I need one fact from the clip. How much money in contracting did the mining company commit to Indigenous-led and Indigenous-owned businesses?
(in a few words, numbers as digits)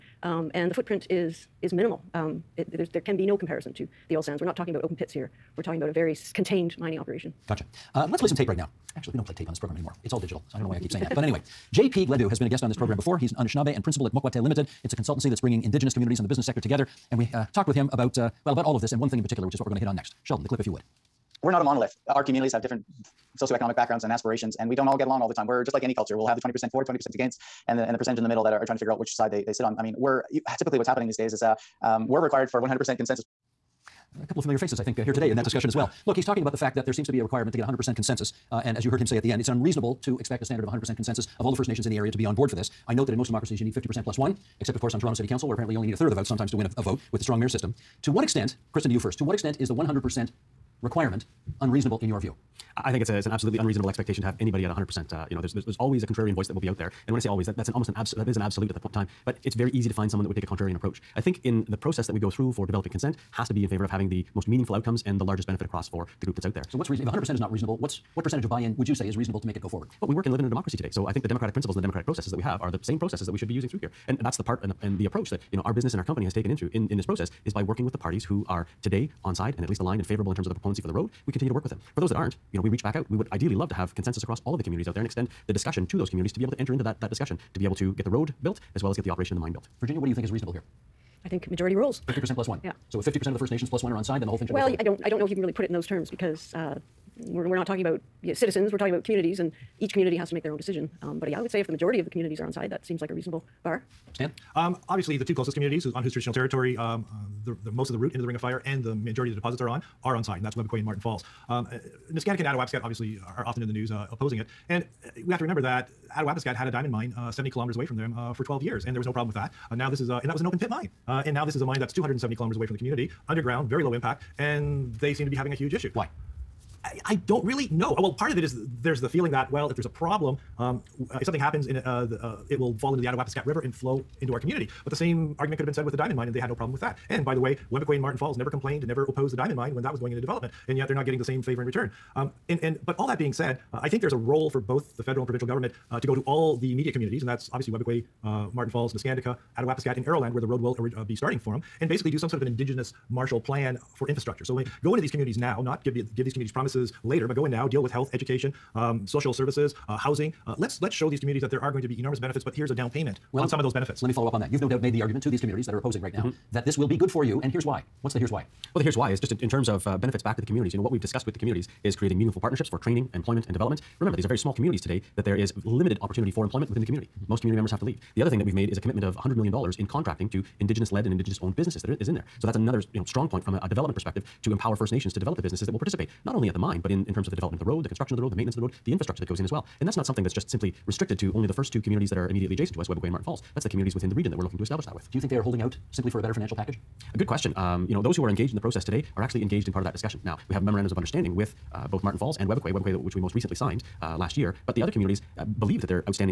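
$100 million.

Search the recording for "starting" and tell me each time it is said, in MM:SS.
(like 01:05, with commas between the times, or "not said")
02:31.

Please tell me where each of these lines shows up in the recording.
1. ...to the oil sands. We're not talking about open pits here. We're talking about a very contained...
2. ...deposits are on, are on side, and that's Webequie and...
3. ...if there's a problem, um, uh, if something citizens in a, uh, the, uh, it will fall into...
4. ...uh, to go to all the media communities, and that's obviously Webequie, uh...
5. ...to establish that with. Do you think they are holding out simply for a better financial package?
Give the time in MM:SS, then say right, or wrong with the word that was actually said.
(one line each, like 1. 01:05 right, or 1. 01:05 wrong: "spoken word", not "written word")
1. 00:03 right
2. 01:49 right
3. 02:09 wrong: "happens", not "citizens"
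4. 02:25 right
5. 03:14 right.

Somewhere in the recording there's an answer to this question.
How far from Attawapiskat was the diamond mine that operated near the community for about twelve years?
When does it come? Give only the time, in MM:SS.
01:57.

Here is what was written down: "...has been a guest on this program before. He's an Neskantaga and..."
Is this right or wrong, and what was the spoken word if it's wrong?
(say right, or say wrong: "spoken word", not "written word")
wrong: "Anishinaabe", not "Neskantaga".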